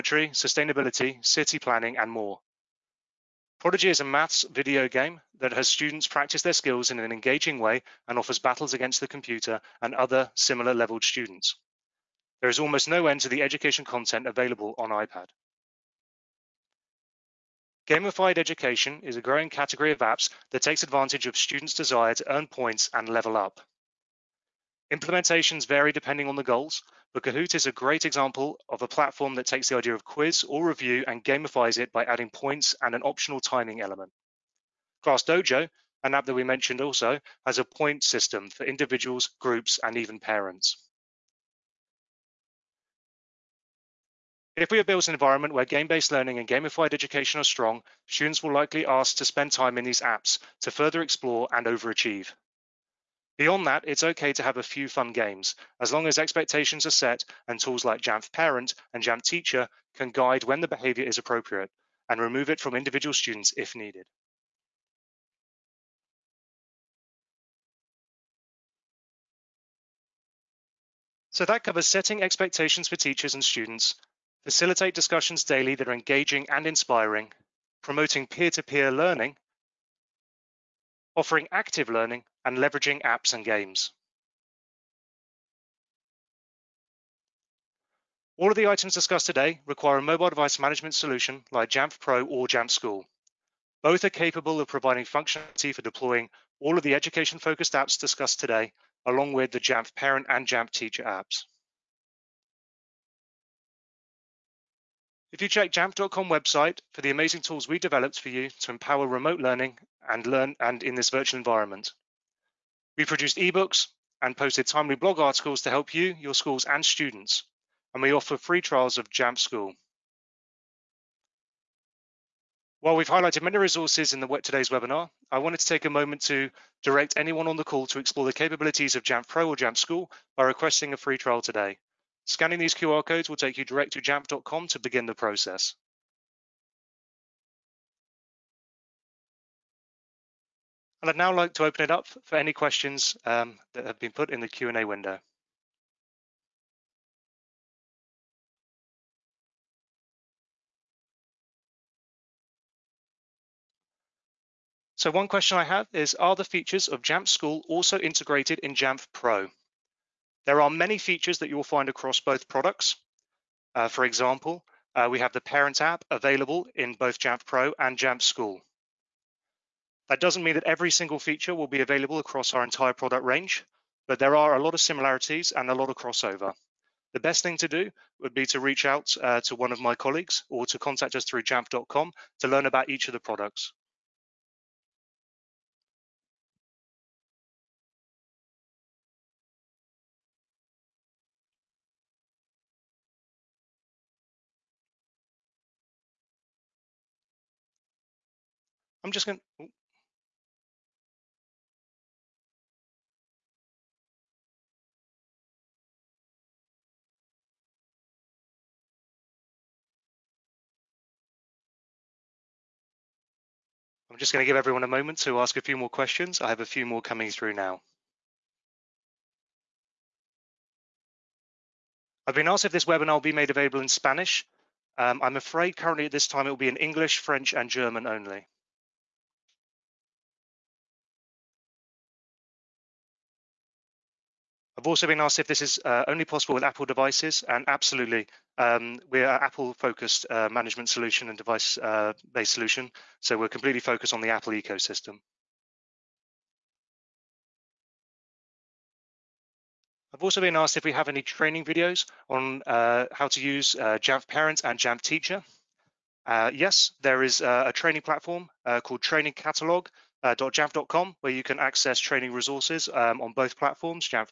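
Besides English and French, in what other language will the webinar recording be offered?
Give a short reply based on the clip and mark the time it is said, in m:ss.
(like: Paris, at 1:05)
German, at 3:47.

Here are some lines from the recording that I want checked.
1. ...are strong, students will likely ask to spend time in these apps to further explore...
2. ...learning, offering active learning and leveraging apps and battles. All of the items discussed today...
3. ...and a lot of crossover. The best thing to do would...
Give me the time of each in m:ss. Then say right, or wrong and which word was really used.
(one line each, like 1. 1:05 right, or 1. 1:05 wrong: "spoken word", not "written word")
1. 0:47 right
2. 1:18 wrong: "games", not "battles"
3. 2:55 right.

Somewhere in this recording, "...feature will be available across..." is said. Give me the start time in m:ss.
2:51.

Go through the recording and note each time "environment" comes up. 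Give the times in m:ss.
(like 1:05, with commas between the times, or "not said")
0:45, 1:51.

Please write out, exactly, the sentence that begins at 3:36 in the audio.
I have a few more coming through now.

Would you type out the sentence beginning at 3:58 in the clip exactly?
Um, we're an Apple-focused uh, management solution and device-based uh, solution, so we're completely focused on the Apple ecosystem.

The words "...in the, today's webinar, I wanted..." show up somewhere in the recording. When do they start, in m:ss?
2:04.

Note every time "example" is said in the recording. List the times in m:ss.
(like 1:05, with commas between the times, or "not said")
0:28, 2:44.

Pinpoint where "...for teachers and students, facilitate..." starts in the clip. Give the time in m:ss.
1:12.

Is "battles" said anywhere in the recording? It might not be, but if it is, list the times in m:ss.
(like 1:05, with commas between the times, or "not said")
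0:08.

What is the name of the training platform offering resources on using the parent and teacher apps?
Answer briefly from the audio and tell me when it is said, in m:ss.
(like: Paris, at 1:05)
Training Catalog, at 4:19.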